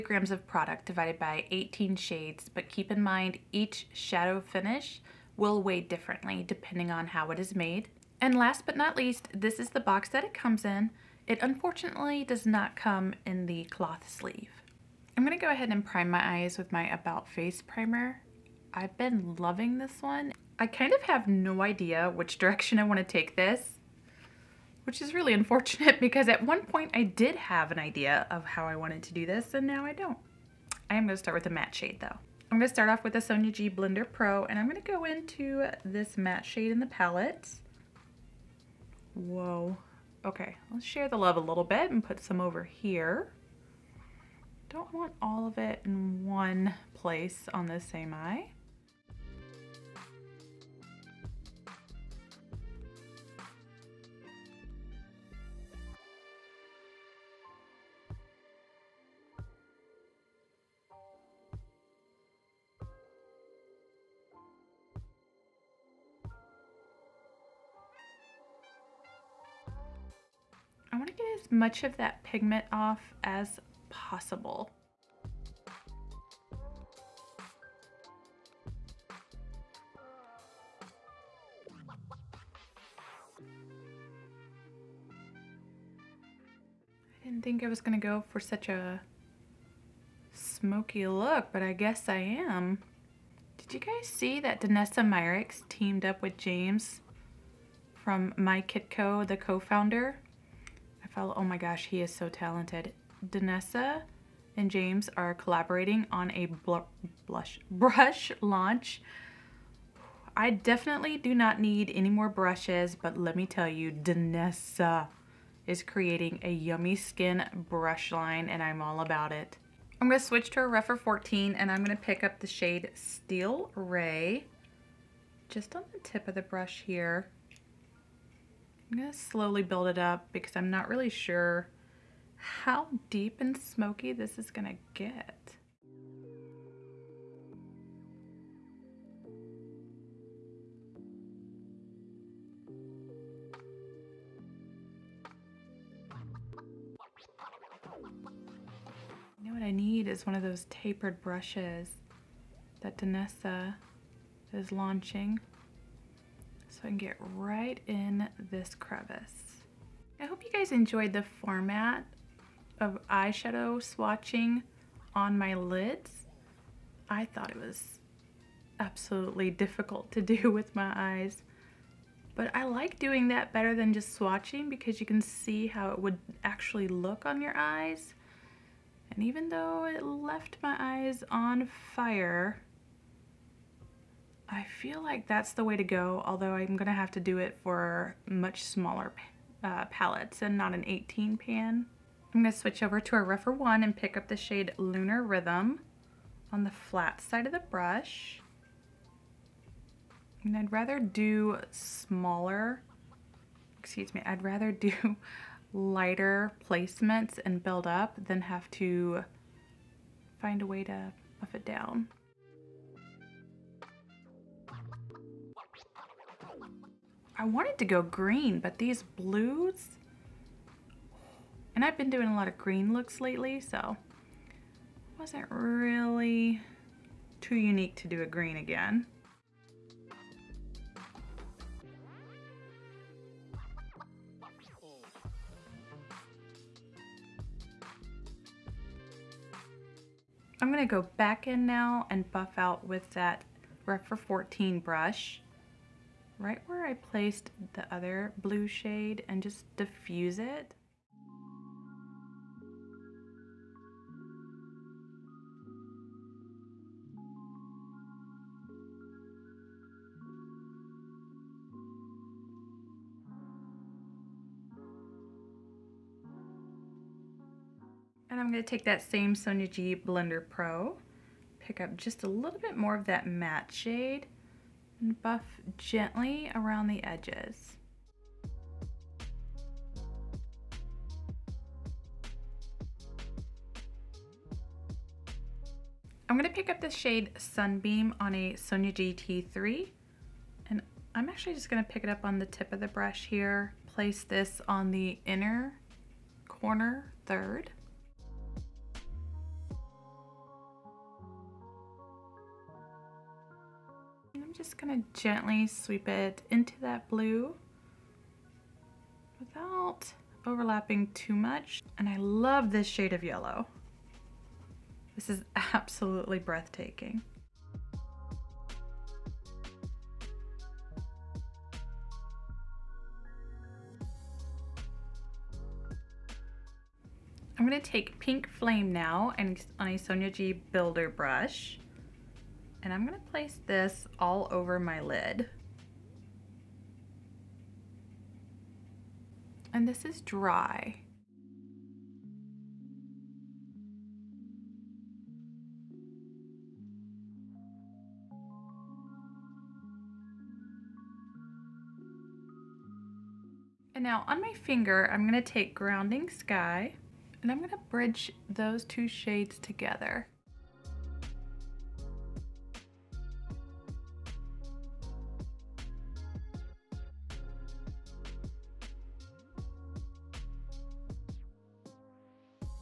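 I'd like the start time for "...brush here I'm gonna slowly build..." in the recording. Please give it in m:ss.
2:06.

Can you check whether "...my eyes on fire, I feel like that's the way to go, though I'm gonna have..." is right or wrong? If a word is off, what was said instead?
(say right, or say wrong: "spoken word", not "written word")
wrong: "although", not "though".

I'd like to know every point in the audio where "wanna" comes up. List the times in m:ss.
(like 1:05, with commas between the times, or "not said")
0:22, 1:10.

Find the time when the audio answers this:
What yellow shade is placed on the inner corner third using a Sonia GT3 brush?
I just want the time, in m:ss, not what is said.
4:47.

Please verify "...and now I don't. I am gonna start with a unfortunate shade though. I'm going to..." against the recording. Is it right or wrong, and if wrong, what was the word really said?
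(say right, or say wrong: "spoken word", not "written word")
wrong: "matte", not "unfortunate".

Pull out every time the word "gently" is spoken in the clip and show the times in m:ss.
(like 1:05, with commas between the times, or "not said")
4:35, 5:05.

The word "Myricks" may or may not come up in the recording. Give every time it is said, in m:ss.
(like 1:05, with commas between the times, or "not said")
1:35.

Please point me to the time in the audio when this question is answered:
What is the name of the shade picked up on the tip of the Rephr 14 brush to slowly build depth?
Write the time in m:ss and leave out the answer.
2:02.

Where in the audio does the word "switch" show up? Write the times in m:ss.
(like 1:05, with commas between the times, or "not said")
2:00, 3:12.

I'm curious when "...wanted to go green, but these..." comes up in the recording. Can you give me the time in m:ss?
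3:37.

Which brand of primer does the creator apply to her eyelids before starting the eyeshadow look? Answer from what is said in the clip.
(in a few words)
About Face.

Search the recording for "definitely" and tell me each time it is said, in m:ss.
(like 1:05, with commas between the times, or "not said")
1:50.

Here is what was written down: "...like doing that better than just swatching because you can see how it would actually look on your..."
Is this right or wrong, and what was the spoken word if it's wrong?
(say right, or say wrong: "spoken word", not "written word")
right.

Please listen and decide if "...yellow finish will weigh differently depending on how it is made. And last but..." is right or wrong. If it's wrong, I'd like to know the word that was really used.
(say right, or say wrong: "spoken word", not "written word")
wrong: "shadow", not "yellow".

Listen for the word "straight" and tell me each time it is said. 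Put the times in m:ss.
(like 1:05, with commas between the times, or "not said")
not said.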